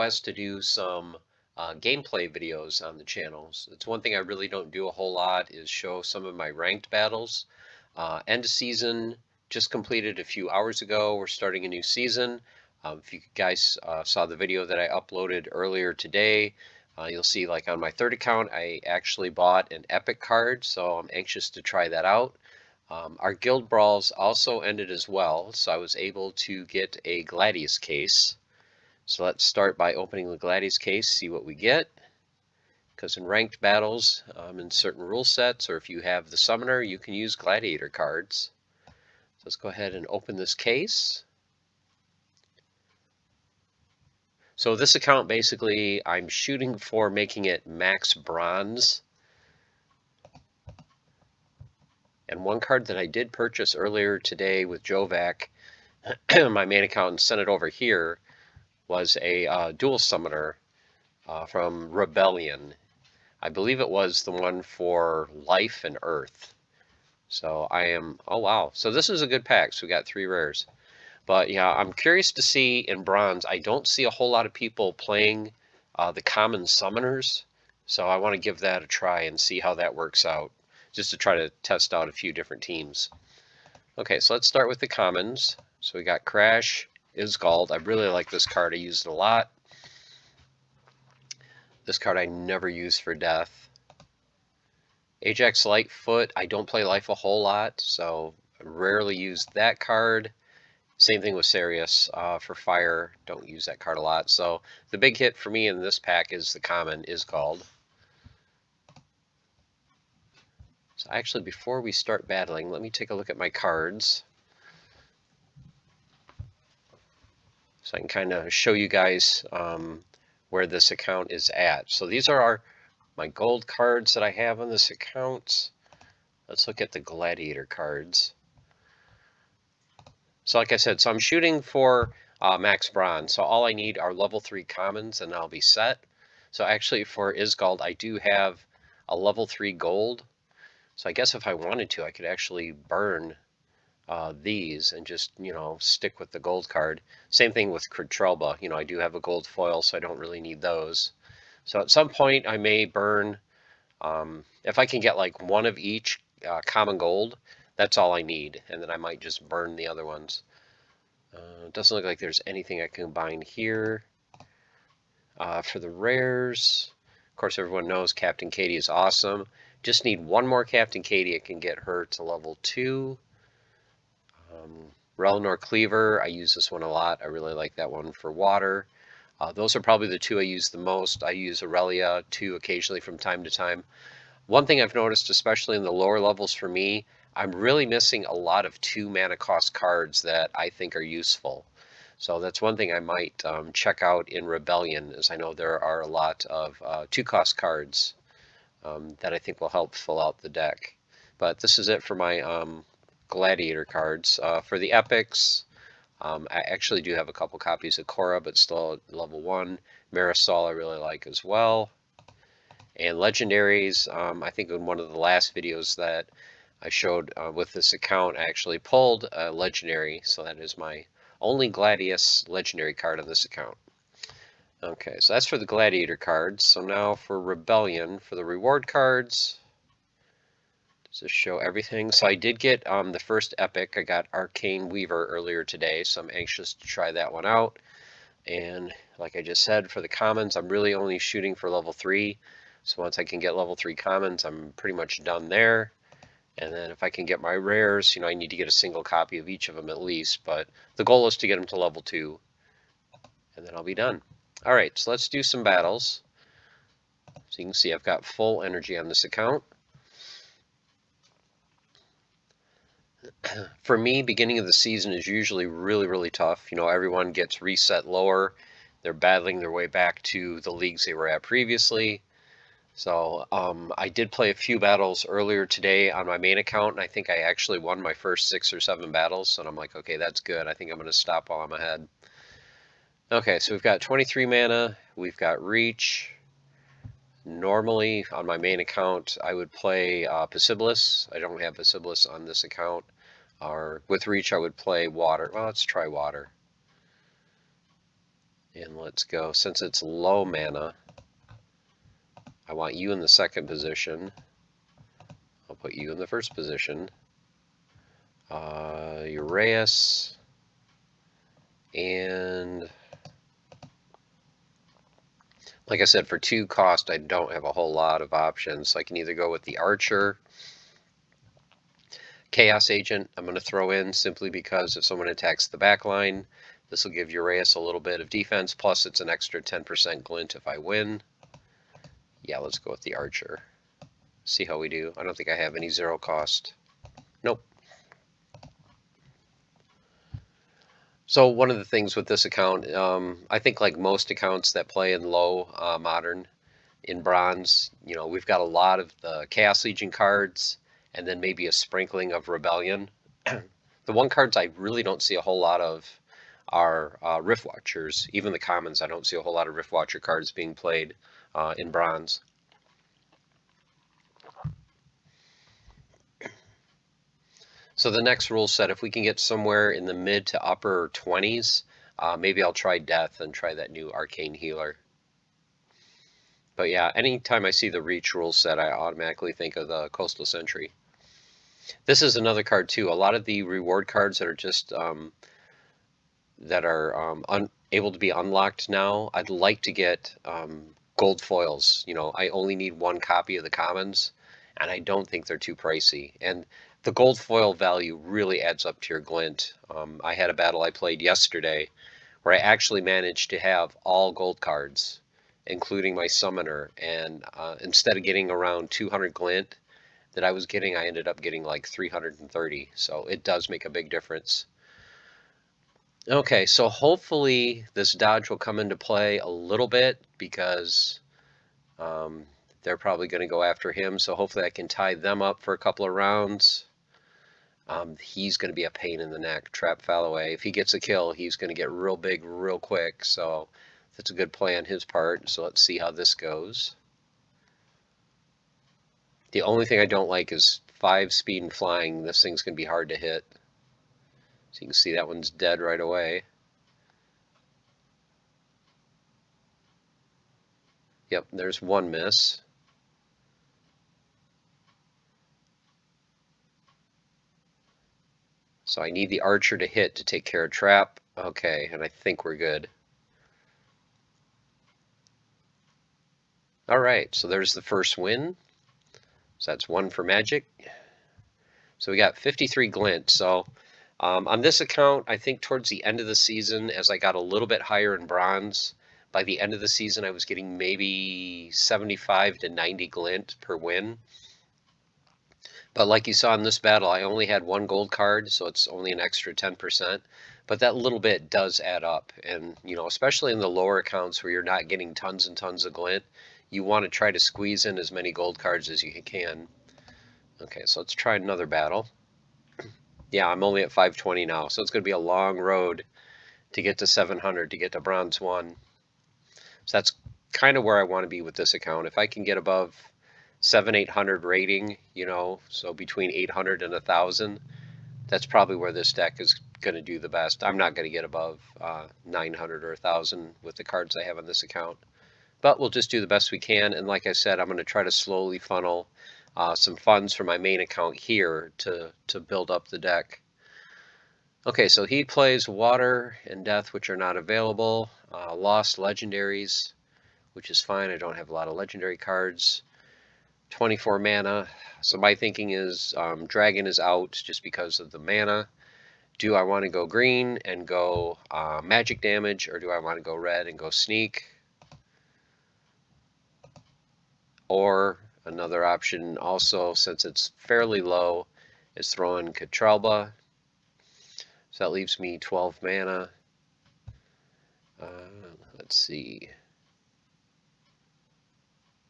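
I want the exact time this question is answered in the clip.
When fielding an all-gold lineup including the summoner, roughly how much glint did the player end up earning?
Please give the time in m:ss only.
6:51.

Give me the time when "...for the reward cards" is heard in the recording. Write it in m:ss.
3:48.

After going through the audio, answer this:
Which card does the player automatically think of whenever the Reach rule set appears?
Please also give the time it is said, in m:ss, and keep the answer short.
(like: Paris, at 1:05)
Coastal Sentry, at 6:20.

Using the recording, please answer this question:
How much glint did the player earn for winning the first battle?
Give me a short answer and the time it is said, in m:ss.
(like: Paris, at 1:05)
53, at 7:52.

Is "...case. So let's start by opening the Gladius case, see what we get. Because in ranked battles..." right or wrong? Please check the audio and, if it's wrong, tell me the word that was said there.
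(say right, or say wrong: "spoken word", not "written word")
right.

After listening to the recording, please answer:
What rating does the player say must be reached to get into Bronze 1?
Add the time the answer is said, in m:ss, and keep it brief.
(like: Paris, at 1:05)
700, at 8:27.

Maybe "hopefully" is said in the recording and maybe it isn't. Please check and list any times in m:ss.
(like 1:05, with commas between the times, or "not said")
6:56, 7:04.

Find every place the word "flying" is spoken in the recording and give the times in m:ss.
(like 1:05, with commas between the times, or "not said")
7:21.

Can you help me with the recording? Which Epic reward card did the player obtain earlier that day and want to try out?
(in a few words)
Arcane Weaver.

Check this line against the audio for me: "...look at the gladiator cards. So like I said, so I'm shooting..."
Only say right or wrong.
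right.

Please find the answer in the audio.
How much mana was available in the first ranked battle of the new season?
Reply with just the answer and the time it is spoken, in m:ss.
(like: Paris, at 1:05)
23, at 4:44.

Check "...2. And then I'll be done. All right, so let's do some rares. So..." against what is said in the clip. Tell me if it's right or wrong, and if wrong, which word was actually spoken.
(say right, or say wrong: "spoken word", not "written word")
wrong: "battles", not "rares".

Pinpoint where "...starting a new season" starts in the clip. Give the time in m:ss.
0:11.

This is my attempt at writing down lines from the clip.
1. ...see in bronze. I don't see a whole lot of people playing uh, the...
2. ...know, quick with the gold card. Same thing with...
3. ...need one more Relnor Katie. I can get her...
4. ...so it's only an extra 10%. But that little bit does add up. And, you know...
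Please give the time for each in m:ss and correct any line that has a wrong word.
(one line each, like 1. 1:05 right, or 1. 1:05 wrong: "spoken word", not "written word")
1. 1:12 right
2. 2:25 wrong: "stick", not "quick"
3. 2:50 wrong: "Captain", not "Relnor"
4. 8:08 right.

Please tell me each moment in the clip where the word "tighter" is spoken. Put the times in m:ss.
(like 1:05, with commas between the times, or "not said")
not said.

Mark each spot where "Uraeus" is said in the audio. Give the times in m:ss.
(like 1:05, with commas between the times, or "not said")
5:09, 5:27.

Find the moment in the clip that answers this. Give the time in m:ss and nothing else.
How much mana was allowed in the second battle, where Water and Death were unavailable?
9:03.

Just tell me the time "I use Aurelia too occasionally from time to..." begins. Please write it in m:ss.
3:01.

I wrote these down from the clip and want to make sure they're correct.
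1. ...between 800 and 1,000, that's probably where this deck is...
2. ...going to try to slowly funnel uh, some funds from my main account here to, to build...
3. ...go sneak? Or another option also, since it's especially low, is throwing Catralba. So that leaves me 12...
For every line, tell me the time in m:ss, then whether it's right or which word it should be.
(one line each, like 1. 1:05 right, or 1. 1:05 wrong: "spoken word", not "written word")
1. 8:35 right
2. 8:47 right
3. 9:13 wrong: "fairly", not "especially".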